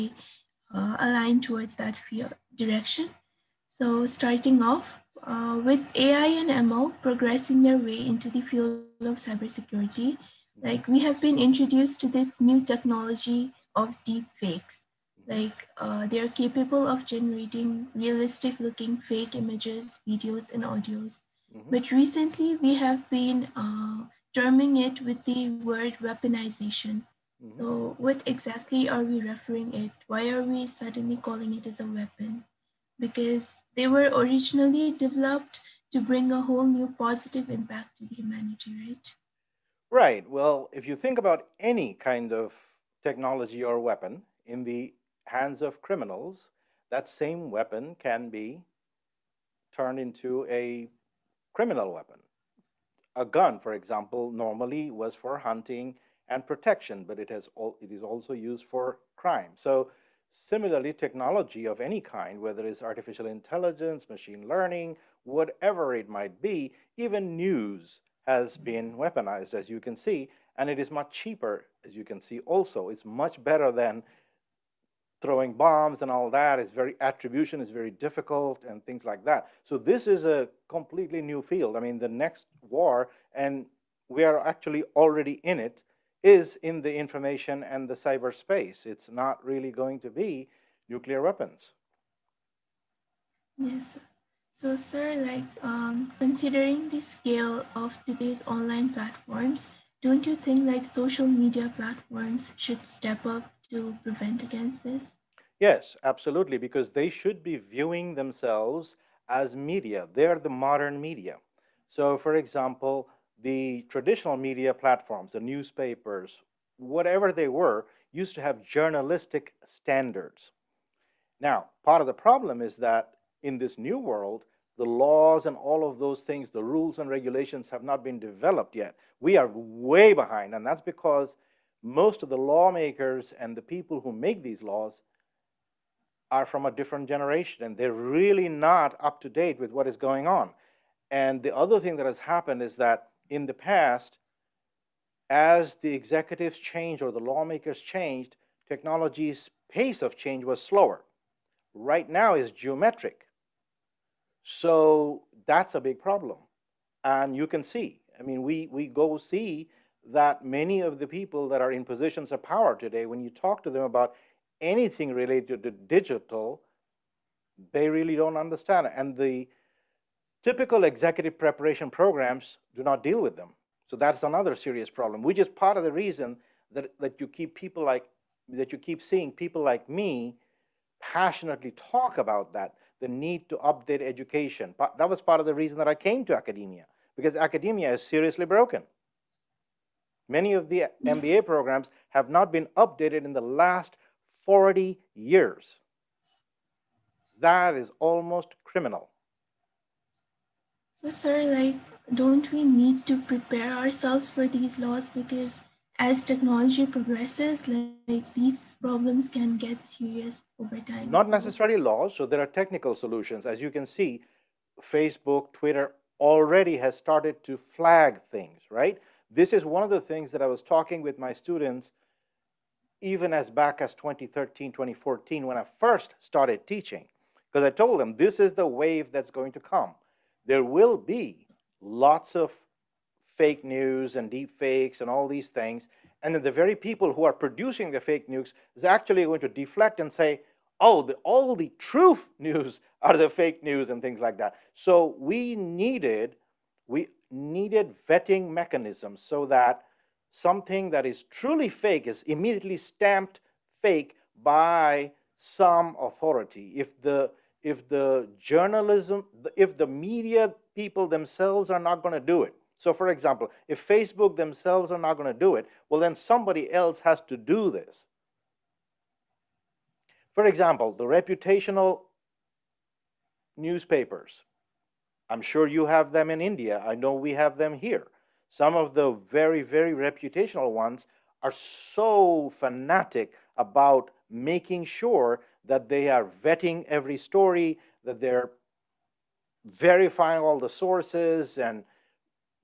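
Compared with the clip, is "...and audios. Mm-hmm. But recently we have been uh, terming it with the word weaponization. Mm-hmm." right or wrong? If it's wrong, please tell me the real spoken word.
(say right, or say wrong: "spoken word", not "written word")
right.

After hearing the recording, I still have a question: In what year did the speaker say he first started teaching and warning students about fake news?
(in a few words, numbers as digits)
2014.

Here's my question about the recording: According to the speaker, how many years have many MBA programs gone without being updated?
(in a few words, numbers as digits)
40 years.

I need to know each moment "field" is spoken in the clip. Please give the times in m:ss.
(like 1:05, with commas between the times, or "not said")
0:01, 0:08, 1:21.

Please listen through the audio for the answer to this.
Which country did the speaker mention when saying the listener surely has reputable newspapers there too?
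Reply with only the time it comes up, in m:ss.
4:36.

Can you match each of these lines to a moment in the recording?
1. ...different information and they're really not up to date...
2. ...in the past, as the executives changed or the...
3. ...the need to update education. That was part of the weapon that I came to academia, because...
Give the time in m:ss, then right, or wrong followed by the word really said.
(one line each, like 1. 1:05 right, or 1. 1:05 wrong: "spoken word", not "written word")
1. 2:16 wrong: "generation", not "information"
2. 2:23 right
3. 3:02 wrong: "reason", not "weapon".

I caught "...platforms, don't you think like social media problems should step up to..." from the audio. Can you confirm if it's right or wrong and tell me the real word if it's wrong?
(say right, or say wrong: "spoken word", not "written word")
wrong: "platforms", not "problems".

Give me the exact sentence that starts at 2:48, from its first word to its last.
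And the typical executive preparation programs do not deal with them.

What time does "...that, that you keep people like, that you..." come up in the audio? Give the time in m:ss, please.
2:56.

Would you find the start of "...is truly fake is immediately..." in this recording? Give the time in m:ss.
4:11.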